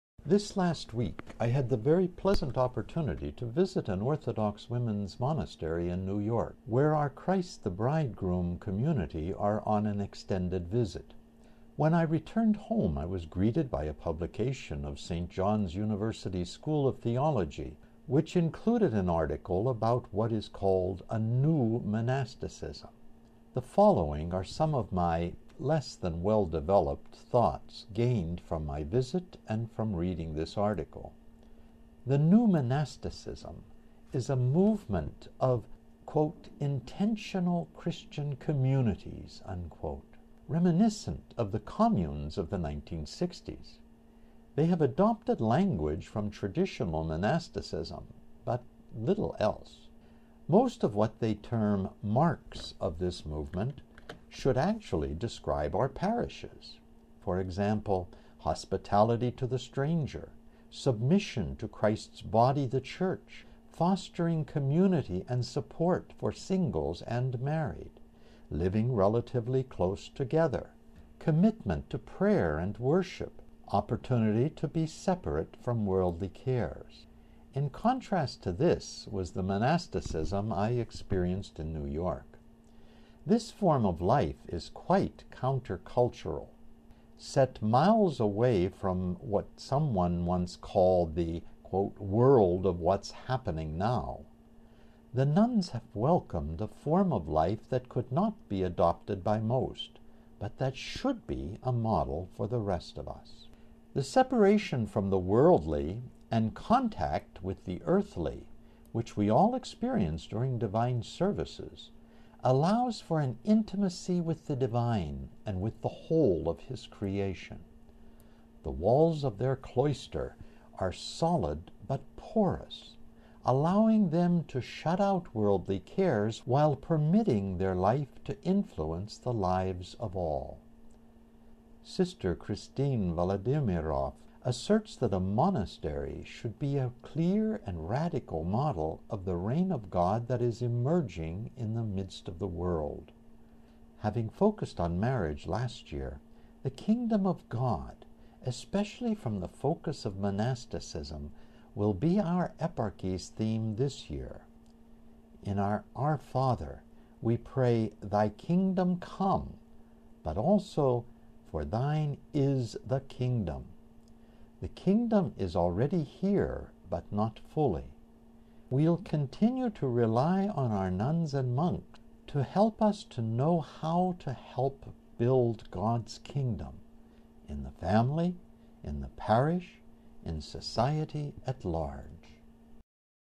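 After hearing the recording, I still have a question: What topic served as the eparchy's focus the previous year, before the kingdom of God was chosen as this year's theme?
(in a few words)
Marriage.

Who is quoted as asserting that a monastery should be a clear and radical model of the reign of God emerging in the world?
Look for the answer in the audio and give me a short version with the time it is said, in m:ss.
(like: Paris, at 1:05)
Sister Christine Vladimiroff, at 2:11.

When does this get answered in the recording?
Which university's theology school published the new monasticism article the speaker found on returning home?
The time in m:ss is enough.
0:15.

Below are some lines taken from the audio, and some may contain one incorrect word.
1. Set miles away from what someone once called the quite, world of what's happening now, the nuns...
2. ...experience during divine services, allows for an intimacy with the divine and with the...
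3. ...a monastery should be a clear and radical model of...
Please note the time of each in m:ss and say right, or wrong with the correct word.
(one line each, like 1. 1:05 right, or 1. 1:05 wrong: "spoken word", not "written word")
1. 1:27 wrong: "quote", not "quite"
2. 1:49 right
3. 2:15 right.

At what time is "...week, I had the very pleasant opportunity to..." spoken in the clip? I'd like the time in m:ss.
0:00.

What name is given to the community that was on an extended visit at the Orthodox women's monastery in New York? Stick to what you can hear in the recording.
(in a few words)
Christ the Bridegroom.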